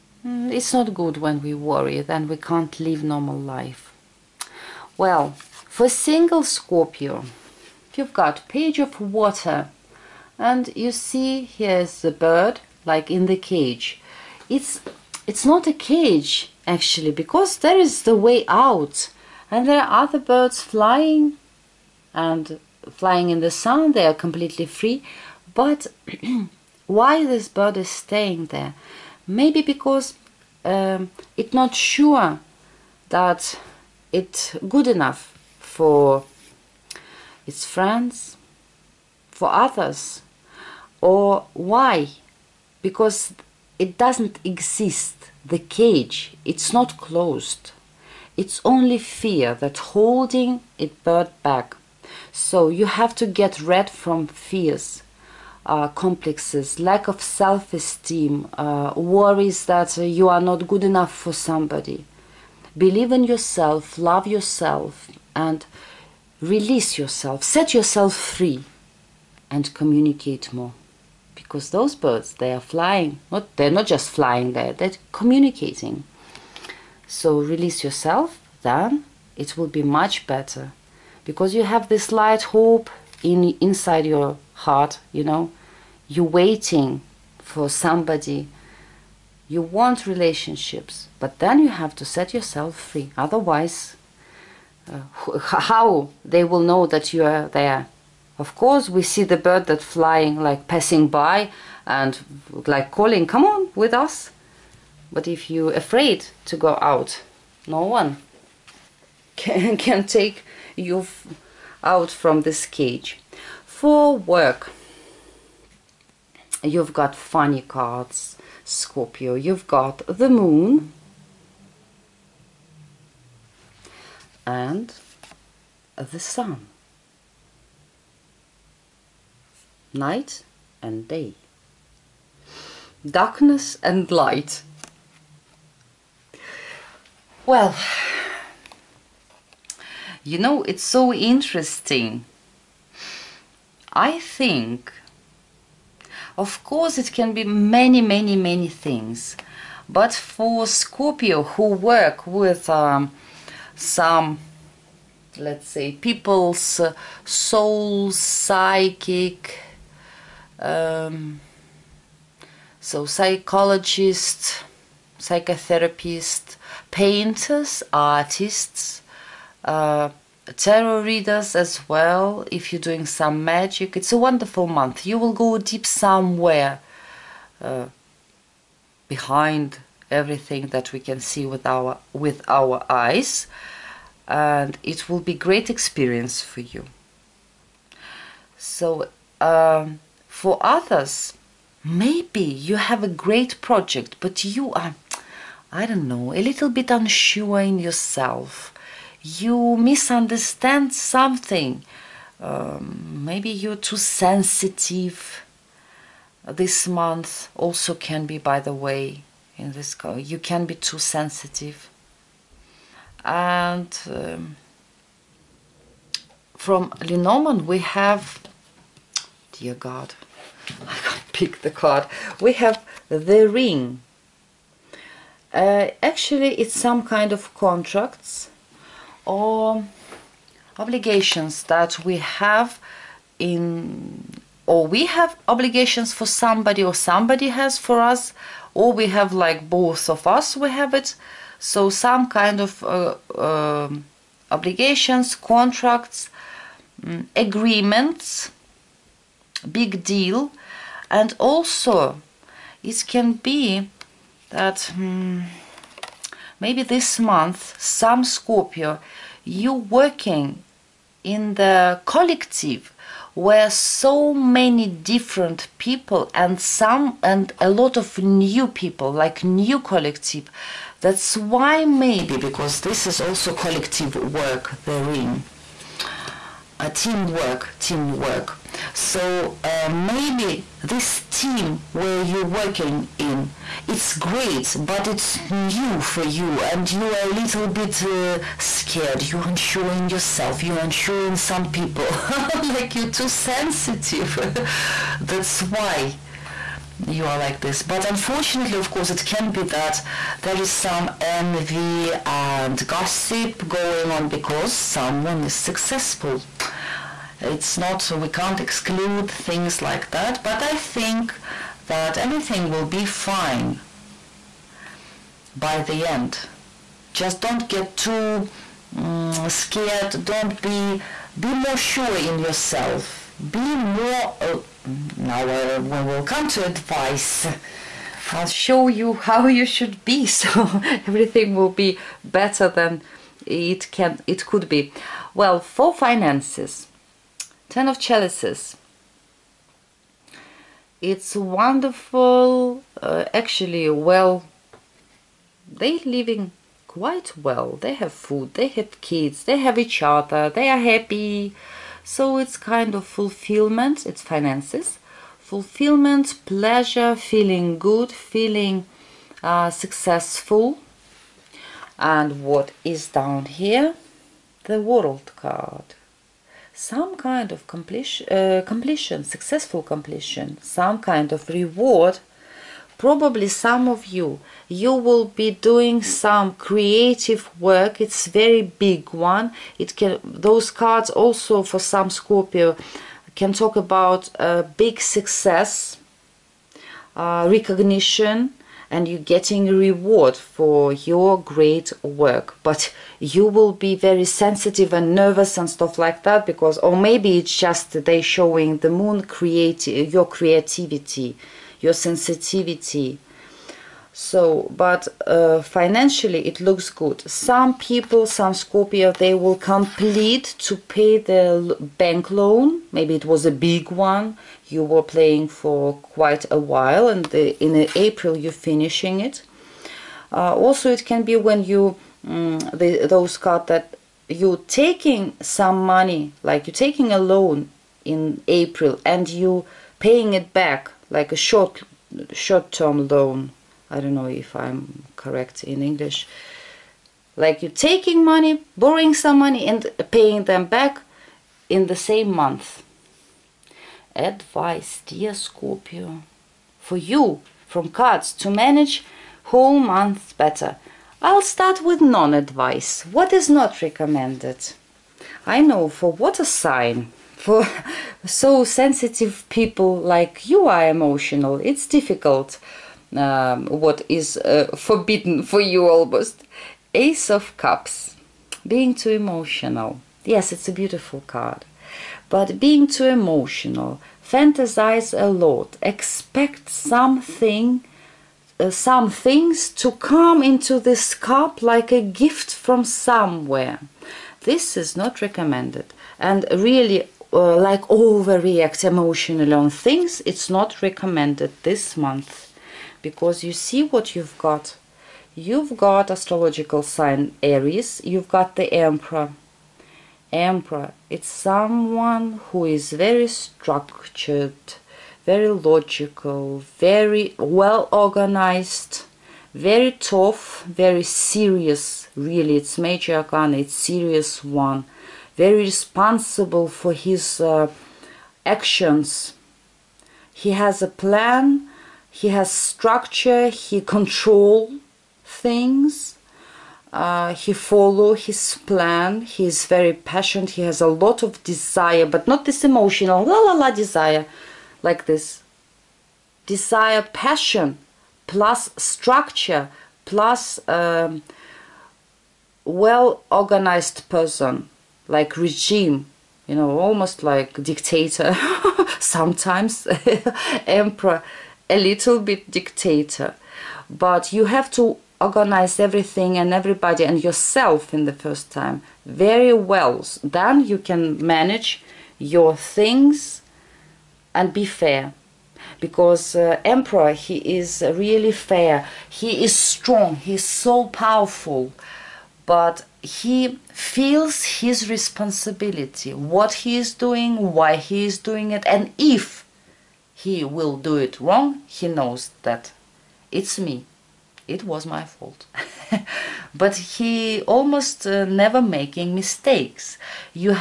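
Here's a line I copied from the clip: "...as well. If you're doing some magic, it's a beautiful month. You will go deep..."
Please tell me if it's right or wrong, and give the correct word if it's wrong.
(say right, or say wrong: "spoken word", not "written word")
wrong: "wonderful", not "beautiful".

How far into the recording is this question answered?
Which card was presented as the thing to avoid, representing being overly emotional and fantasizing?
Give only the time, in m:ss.
7:46.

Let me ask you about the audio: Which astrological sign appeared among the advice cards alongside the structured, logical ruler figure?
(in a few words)
Aries.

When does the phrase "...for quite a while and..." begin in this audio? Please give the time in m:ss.
6:55.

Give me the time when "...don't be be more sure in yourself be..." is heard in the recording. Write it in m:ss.
5:20.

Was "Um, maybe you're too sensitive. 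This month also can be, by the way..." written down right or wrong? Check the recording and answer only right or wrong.
right.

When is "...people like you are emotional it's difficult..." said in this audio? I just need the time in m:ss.
7:39.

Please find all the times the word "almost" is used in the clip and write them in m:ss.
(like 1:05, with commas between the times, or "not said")
7:45, 9:06, 9:47.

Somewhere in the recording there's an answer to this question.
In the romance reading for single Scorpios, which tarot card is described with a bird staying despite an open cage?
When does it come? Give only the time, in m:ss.
0:08.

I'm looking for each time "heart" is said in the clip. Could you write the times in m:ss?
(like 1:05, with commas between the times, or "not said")
1:24.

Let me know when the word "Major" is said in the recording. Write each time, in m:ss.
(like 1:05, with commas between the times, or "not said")
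8:32.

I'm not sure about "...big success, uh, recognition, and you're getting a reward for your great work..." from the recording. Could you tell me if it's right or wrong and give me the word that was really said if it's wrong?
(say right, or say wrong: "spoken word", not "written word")
right.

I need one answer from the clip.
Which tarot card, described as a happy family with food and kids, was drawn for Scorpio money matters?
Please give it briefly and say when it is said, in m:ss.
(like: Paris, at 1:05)
Ten of Chalices, at 5:37.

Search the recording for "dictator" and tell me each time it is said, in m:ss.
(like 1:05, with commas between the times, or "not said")
9:07, 9:12.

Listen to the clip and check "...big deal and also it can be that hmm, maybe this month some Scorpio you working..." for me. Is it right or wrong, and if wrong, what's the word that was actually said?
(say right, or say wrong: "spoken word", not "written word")
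right.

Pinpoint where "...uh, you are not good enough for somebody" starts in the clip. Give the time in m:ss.
0:59.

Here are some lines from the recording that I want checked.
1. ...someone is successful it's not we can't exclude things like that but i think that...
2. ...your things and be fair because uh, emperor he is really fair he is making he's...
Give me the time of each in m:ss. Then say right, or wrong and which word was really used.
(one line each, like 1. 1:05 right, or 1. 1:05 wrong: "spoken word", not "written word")
1. 5:04 right
2. 9:22 wrong: "strong", not "making".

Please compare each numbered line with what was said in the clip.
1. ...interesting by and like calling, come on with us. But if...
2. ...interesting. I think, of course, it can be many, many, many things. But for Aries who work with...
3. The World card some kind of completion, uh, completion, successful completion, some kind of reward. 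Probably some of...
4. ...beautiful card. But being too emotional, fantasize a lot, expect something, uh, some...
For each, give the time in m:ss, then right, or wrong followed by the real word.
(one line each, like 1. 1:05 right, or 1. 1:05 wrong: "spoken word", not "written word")
1. 1:40 wrong: "passing", not "interesting"
2. 2:21 wrong: "Scorpio", not "Aries"
3. 6:04 right
4. 7:50 right.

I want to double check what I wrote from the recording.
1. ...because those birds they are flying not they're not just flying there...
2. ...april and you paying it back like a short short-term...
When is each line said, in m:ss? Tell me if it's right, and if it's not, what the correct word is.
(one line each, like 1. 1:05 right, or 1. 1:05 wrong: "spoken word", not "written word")
1. 1:11 right
2. 7:08 right.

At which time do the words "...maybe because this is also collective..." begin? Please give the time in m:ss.
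4:31.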